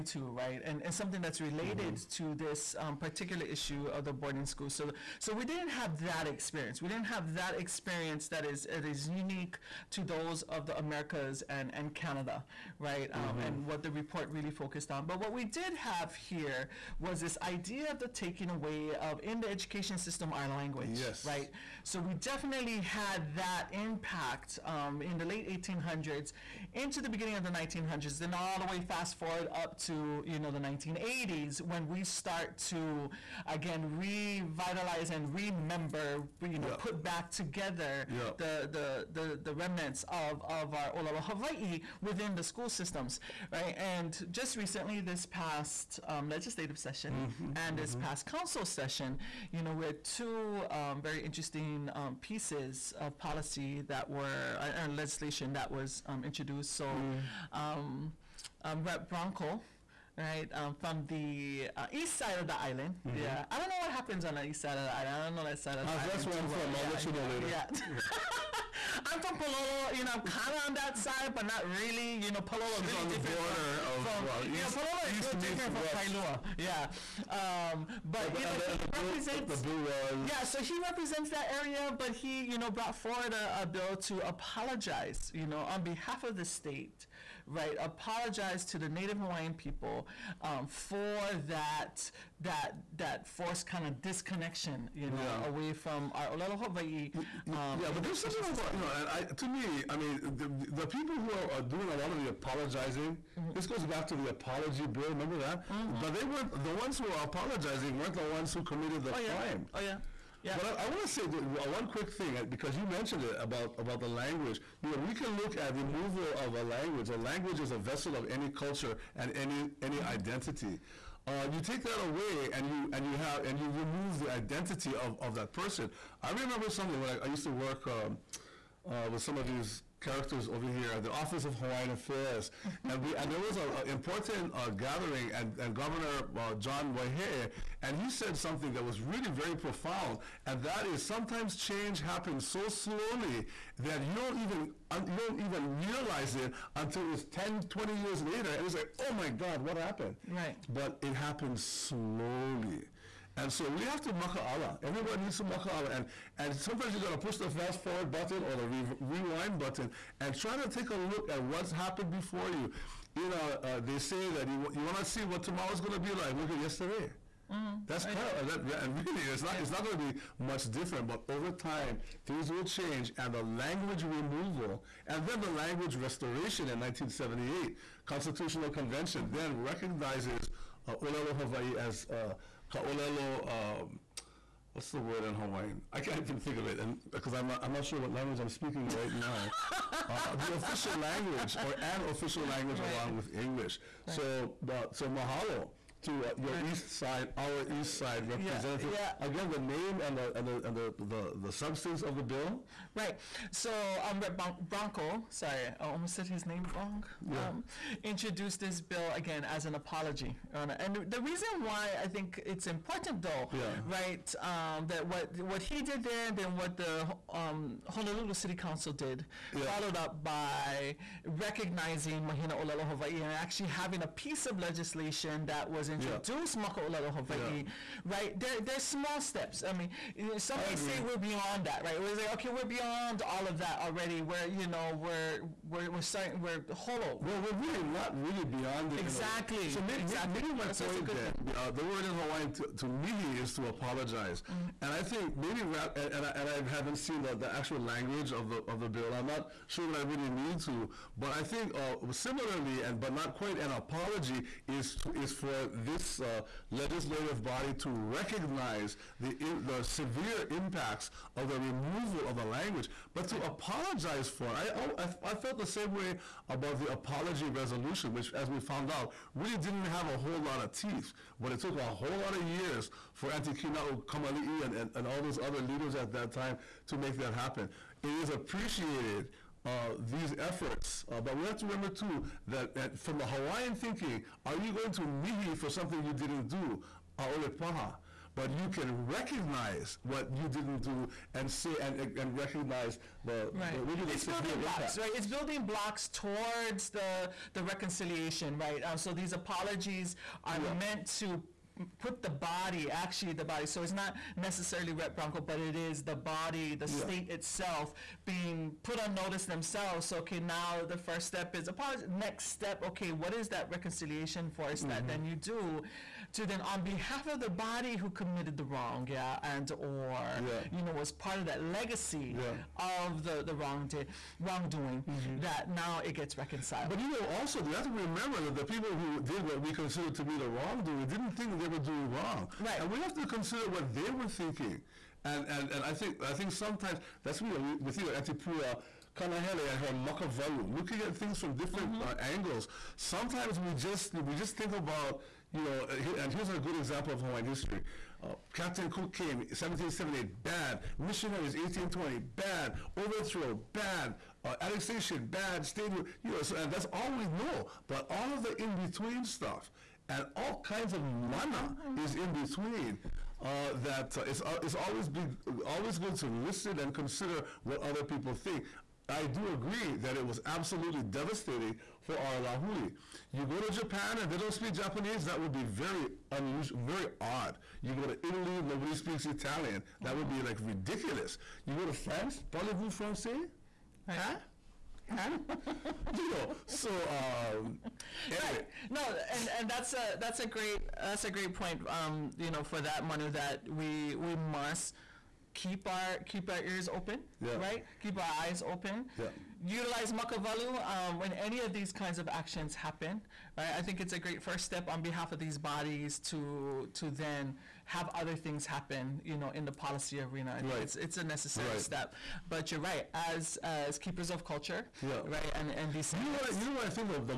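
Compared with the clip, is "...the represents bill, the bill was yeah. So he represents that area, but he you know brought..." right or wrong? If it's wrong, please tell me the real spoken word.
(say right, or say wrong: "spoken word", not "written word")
right.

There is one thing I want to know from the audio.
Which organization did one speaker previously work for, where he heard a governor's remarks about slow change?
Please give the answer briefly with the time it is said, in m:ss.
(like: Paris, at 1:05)
Office of Hawaiian Affairs, at 2:11.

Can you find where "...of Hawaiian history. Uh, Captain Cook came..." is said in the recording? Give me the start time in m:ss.
5:47.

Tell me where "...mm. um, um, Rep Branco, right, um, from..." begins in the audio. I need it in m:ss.
0:57.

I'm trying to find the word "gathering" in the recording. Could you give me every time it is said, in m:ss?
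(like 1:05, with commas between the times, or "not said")
2:14.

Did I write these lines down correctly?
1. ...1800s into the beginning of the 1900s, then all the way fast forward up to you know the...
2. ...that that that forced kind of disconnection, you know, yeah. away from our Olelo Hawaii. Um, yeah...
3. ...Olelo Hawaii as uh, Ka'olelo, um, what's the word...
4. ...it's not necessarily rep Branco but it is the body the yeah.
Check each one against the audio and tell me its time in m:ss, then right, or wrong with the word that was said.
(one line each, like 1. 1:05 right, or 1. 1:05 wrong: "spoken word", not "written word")
1. 0:25 right
2. 1:31 right
3. 3:01 right
4. 5:03 right.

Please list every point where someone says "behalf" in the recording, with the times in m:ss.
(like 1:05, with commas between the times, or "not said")
1:25, 5:16, 6:45.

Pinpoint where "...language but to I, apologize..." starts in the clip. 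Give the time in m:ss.
4:22.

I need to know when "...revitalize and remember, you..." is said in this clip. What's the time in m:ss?
0:33.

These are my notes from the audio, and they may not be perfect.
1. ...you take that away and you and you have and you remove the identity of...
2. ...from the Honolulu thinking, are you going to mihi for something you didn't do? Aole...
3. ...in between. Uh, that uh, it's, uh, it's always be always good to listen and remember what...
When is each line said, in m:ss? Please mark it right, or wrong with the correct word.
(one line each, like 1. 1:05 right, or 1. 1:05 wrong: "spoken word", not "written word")
1. 2:01 right
2. 4:42 wrong: "Hawaiian", not "Honolulu"
3. 6:02 wrong: "consider", not "remember".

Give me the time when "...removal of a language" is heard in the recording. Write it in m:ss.
1:55.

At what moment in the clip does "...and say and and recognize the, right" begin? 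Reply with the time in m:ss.
4:51.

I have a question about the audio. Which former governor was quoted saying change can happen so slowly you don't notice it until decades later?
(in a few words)
John Waihee.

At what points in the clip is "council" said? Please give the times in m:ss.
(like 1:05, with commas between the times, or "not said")
0:48, 3:38.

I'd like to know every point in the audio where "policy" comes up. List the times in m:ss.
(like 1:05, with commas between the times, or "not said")
0:53, 6:49.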